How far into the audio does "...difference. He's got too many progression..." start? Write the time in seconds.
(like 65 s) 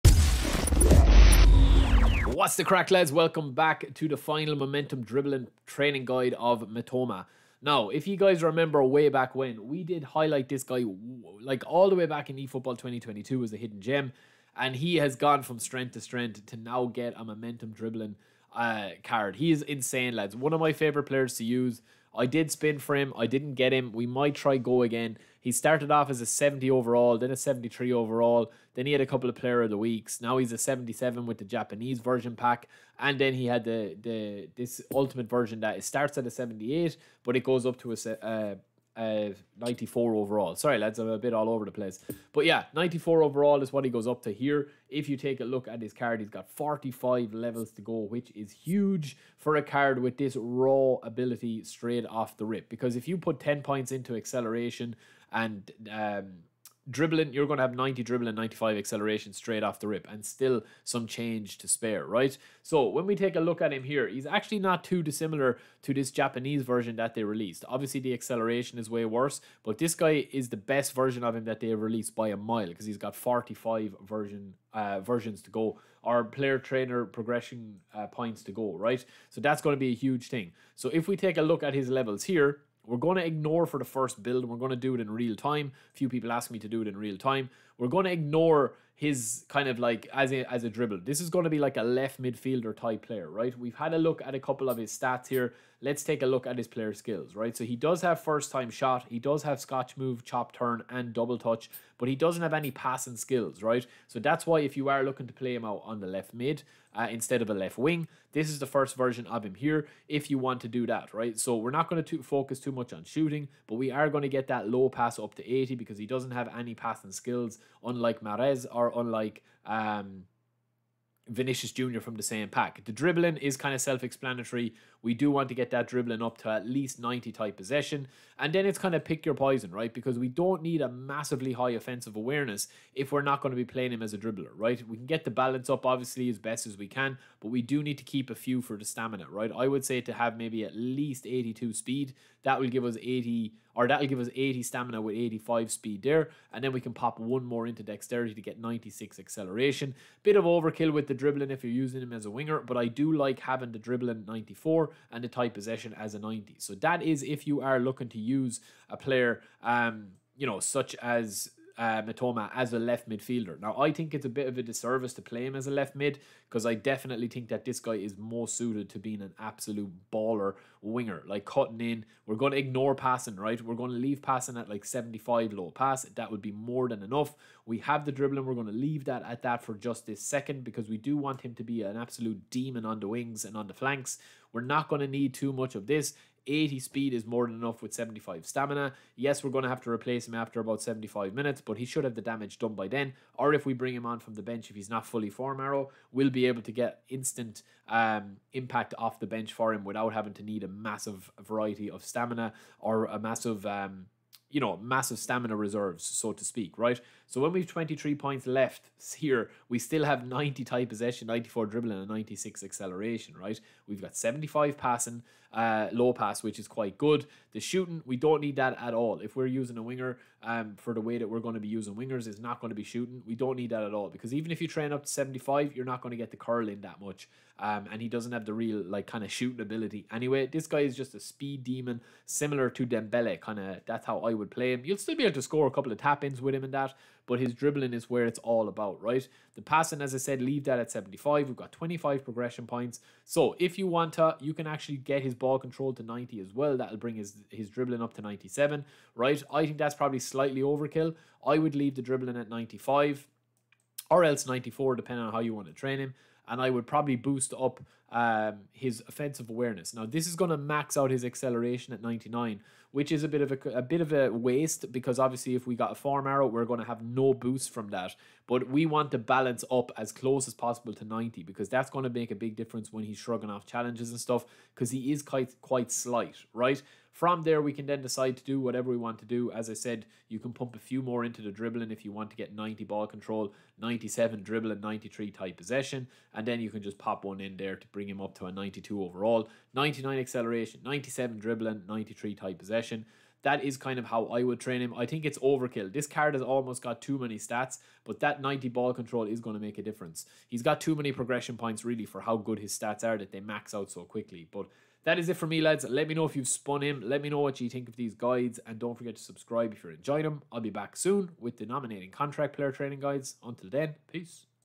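299 s.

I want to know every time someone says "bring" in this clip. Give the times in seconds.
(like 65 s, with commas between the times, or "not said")
193 s, 246 s, 287 s.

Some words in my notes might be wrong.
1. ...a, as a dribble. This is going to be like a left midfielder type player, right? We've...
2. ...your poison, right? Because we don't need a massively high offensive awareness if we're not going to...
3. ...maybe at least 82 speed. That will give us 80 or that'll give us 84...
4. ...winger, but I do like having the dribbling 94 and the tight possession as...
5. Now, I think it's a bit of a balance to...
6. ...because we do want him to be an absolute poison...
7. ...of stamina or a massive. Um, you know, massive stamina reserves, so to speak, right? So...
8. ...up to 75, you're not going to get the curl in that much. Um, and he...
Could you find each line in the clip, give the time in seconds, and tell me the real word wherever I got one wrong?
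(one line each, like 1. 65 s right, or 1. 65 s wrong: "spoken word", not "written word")
1. 90 s right
2. 129 s right
3. 140 s wrong: "80", not "84"
4. 152 s right
5. 163 s wrong: "disservice", not "balance"
6. 180 s wrong: "demon", not "poison"
7. 201 s right
8. 224 s right.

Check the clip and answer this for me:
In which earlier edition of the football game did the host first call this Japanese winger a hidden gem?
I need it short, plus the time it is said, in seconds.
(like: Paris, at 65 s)
eFootball 2022, at 12 s.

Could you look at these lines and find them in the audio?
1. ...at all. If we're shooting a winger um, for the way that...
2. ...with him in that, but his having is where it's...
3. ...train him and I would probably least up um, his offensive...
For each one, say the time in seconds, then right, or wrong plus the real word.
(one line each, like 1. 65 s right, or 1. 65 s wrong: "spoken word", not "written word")
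1. 218 s wrong: "using", not "shooting"
2. 236 s wrong: "dribbling", not "having"
3. 255 s wrong: "boost", not "least".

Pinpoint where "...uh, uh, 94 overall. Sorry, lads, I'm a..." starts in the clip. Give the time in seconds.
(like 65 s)
38 s.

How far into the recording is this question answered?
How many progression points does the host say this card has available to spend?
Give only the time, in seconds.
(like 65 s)
46 s.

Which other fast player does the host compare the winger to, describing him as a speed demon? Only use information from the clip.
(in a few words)
Dembele.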